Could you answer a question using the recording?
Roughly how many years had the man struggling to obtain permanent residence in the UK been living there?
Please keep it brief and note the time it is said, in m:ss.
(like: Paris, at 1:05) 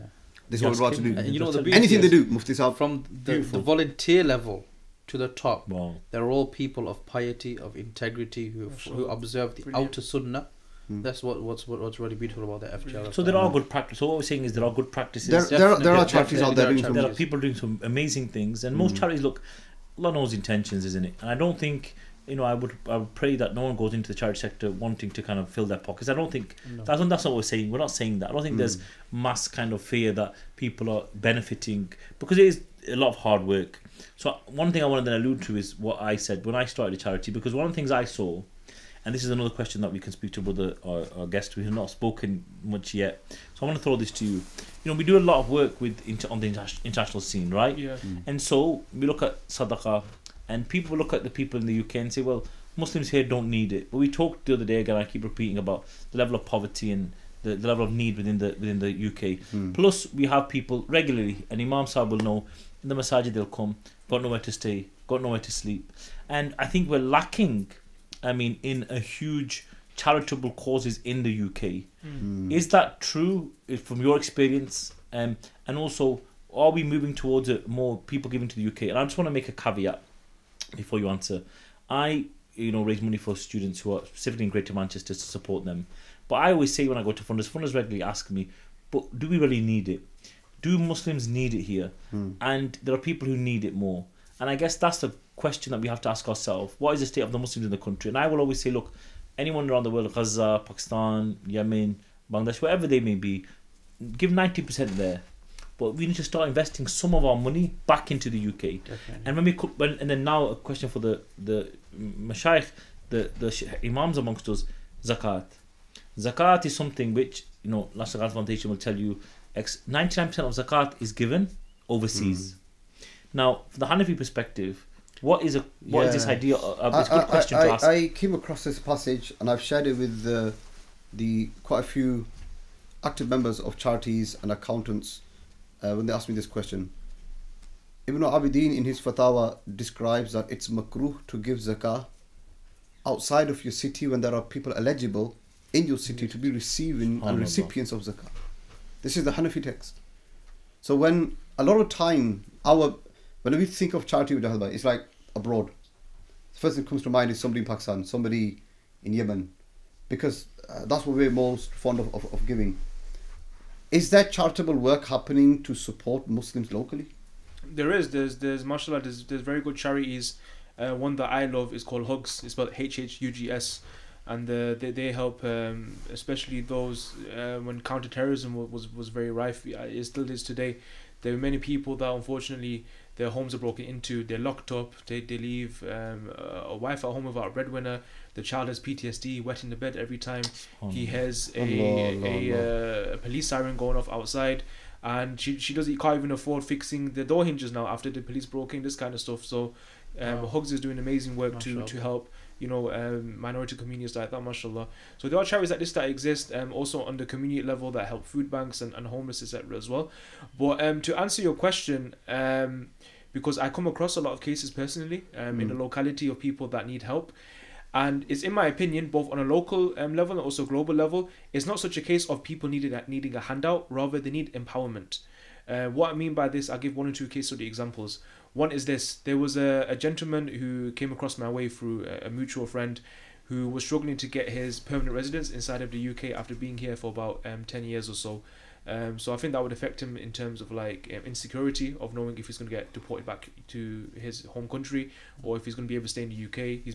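10 years, at 3:57.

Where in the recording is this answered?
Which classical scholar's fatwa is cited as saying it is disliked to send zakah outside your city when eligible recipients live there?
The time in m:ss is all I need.
2:18.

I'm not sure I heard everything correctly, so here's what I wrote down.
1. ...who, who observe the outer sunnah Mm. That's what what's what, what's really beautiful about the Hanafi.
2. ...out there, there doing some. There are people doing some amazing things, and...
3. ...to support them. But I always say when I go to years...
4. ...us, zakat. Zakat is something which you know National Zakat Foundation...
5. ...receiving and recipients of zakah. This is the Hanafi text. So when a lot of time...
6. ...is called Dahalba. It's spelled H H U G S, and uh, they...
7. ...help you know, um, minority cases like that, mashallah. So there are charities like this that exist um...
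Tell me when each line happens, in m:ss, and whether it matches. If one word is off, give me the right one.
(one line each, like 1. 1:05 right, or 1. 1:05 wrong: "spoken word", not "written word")
1. 0:08 wrong: "FGL", not "Hanafi"
2. 0:16 right
3. 1:25 wrong: "funders", not "years"
4. 1:54 right
5. 2:26 right
6. 2:51 wrong: "Hugs", not "Dahalba"
7. 3:21 wrong: "communities", not "cases".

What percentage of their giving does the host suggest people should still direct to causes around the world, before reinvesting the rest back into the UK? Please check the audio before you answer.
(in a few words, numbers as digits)
90%.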